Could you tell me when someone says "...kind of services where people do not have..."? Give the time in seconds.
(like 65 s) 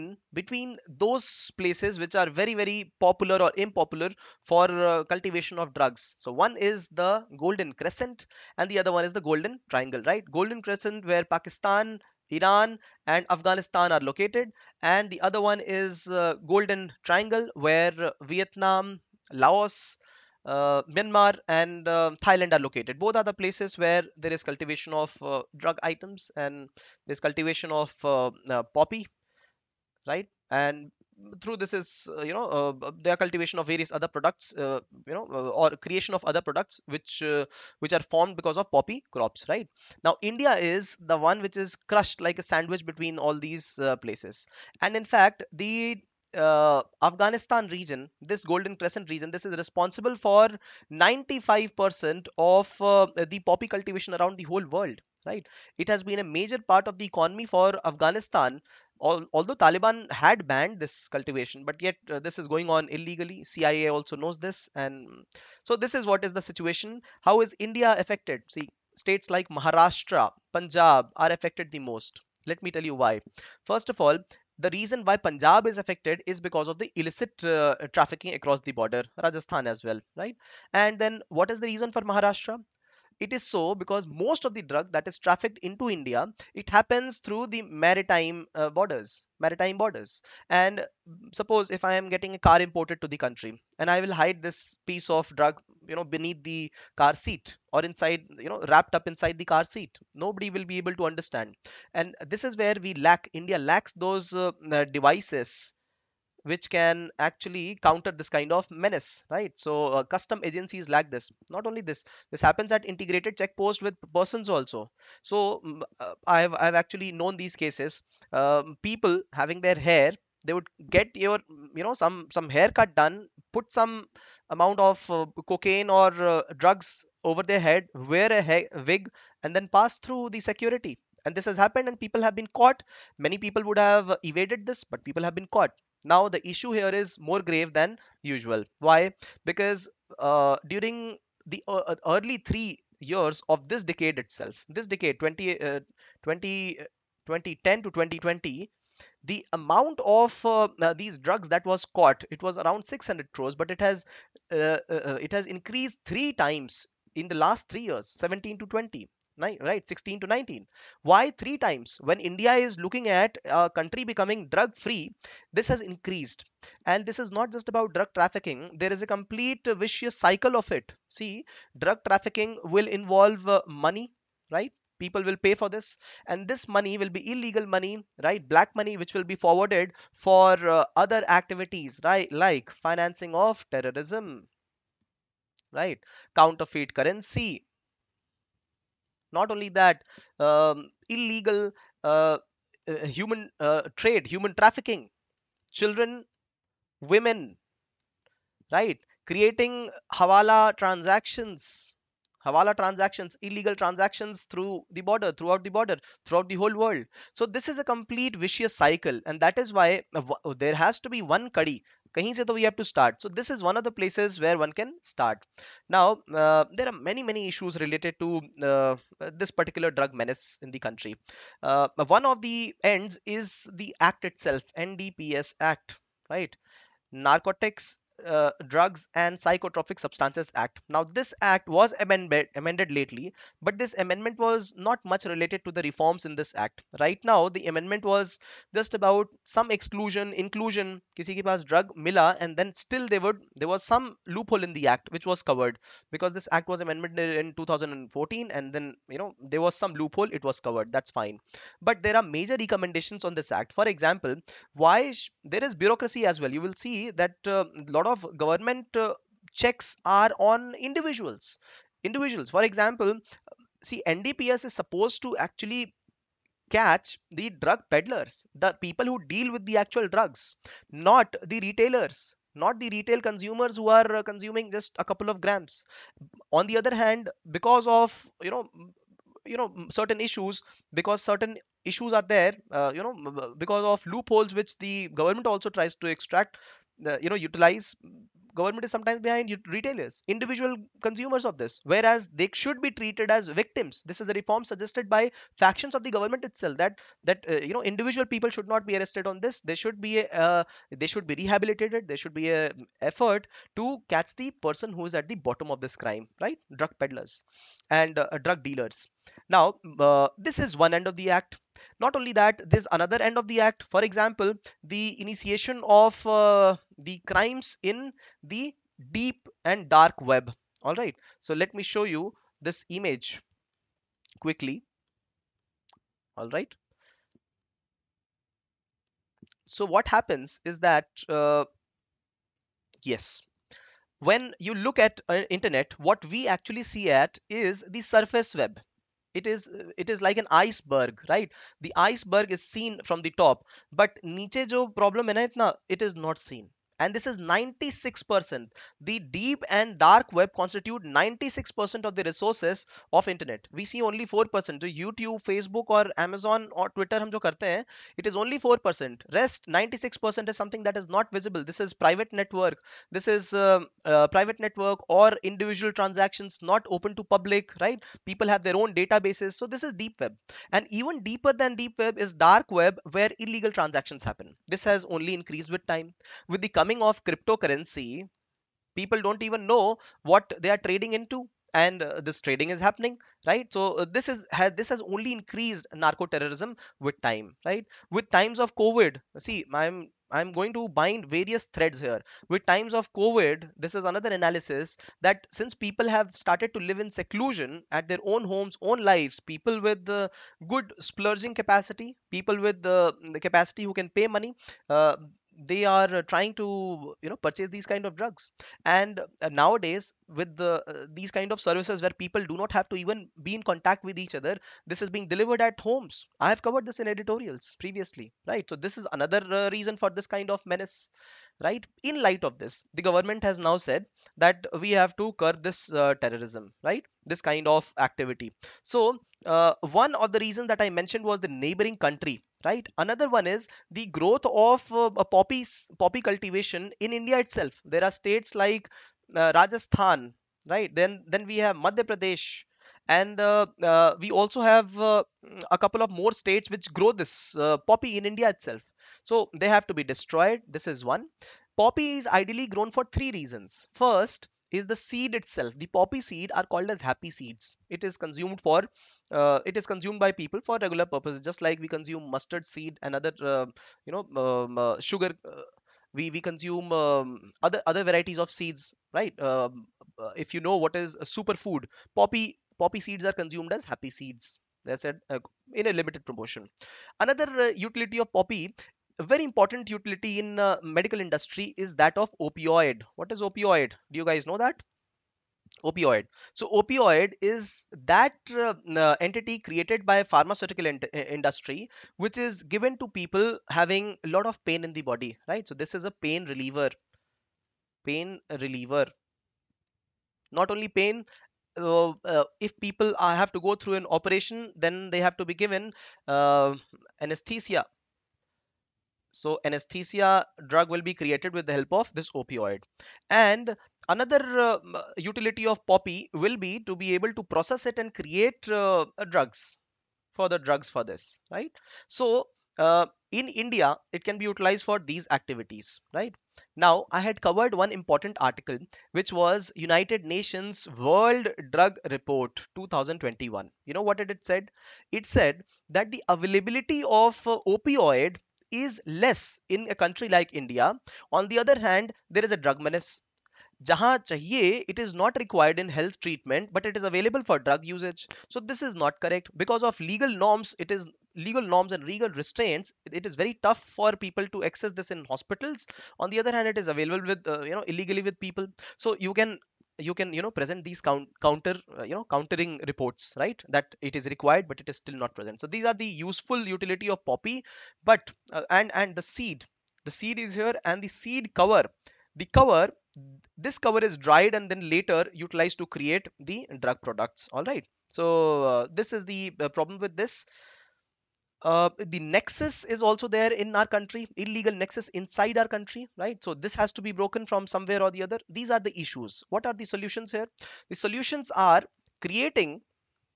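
411 s.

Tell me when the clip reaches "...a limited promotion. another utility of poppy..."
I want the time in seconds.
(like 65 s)
475 s.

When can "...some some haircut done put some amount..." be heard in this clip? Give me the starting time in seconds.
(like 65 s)
121 s.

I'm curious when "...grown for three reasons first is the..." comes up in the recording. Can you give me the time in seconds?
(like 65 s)
452 s.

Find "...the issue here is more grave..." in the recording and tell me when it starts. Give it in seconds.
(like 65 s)
136 s.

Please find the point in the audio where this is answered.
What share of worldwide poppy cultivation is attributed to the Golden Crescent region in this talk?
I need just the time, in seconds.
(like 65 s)
50 s.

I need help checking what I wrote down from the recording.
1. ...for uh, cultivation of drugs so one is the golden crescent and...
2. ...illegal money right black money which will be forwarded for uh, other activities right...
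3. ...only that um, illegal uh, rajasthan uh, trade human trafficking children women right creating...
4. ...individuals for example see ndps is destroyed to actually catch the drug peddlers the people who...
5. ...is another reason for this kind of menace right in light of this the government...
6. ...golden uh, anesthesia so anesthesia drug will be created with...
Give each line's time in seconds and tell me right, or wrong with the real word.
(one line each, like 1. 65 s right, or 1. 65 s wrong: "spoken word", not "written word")
1. 4 s right
2. 177 s right
3. 189 s wrong: "human", not "rajasthan"
4. 262 s wrong: "supposed", not "destroyed"
5. 418 s right
6. 505 s wrong: "given", not "golden".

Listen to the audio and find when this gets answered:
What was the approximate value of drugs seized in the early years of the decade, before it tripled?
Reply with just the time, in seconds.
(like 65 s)
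152 s.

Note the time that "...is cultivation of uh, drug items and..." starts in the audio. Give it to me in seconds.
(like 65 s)
24 s.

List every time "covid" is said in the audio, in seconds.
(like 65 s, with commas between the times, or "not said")
388 s, 393 s.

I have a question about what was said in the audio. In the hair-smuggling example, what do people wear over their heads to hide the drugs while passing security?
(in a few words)
A wig.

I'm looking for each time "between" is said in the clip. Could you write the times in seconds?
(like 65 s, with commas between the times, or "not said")
0 s, 42 s.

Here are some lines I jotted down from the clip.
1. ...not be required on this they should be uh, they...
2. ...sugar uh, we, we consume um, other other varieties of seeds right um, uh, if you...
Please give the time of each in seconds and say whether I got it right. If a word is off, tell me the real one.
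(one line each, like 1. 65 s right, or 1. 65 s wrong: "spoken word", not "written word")
1. 298 s wrong: "arrested", not "required"
2. 464 s right.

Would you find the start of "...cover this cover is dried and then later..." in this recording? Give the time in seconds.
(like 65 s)
572 s.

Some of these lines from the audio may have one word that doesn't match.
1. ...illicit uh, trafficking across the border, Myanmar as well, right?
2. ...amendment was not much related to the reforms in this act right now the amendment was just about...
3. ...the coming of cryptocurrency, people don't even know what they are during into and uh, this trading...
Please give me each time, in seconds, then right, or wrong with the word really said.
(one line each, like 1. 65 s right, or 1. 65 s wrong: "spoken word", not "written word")
1. 76 s wrong: "Rajasthan", not "Myanmar"
2. 233 s right
3. 376 s wrong: "trading", not "during".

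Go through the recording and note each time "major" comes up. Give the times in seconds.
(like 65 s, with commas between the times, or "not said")
56 s, 252 s.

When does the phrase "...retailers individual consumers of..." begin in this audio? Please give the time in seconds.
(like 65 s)
289 s.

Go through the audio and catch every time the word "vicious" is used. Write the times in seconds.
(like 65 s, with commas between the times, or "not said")
169 s, 208 s.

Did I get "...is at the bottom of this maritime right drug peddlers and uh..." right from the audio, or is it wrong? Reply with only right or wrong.
wrong.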